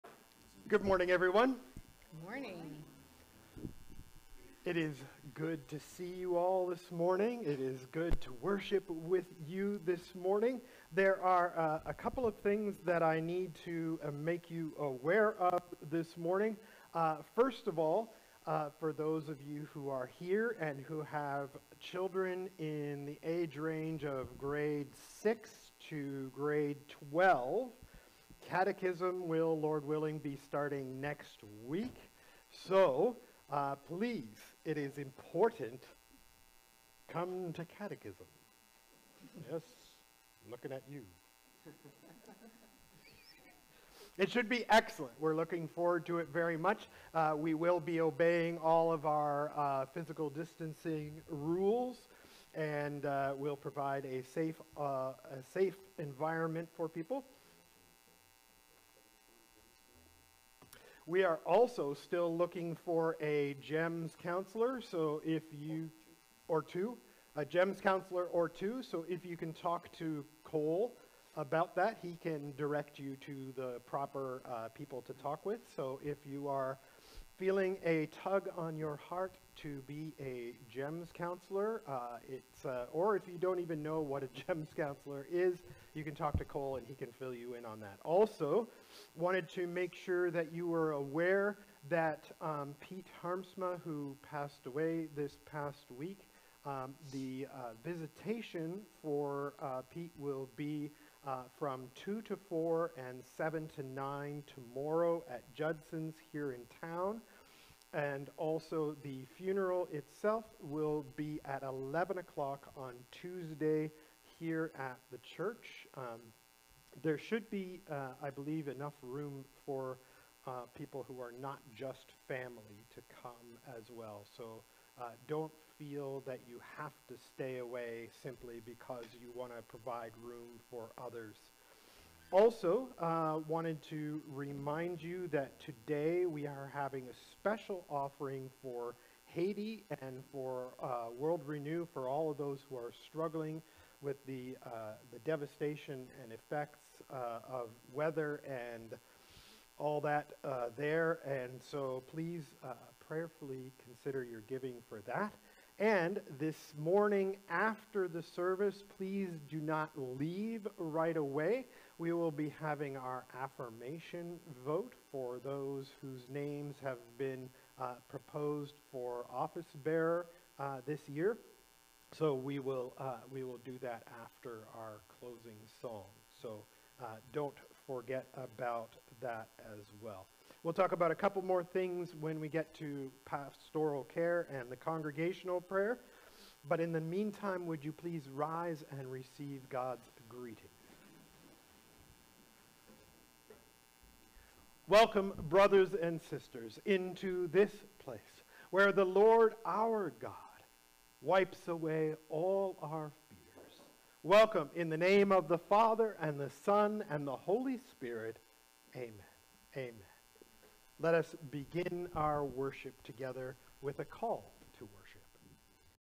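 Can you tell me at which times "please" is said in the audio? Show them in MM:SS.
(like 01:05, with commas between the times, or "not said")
00:33, 02:32, 02:38, 03:07.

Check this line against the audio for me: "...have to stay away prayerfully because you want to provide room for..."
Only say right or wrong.
wrong.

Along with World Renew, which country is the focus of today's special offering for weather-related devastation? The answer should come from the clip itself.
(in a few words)
Haiti.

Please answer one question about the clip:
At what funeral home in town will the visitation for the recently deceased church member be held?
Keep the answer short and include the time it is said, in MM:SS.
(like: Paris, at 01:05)
Judson's, at 01:45.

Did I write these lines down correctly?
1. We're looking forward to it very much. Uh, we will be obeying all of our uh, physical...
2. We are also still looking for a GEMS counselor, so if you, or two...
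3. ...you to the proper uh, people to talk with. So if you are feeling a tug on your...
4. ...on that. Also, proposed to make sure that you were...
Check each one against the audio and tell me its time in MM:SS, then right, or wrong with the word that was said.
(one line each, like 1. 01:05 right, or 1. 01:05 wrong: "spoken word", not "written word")
1. 00:45 right
2. 01:01 right
3. 01:12 right
4. 01:27 wrong: "wanted", not "proposed".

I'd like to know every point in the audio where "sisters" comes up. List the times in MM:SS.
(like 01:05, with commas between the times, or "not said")
03:16.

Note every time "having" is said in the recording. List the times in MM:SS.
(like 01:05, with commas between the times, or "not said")
02:16, 02:42.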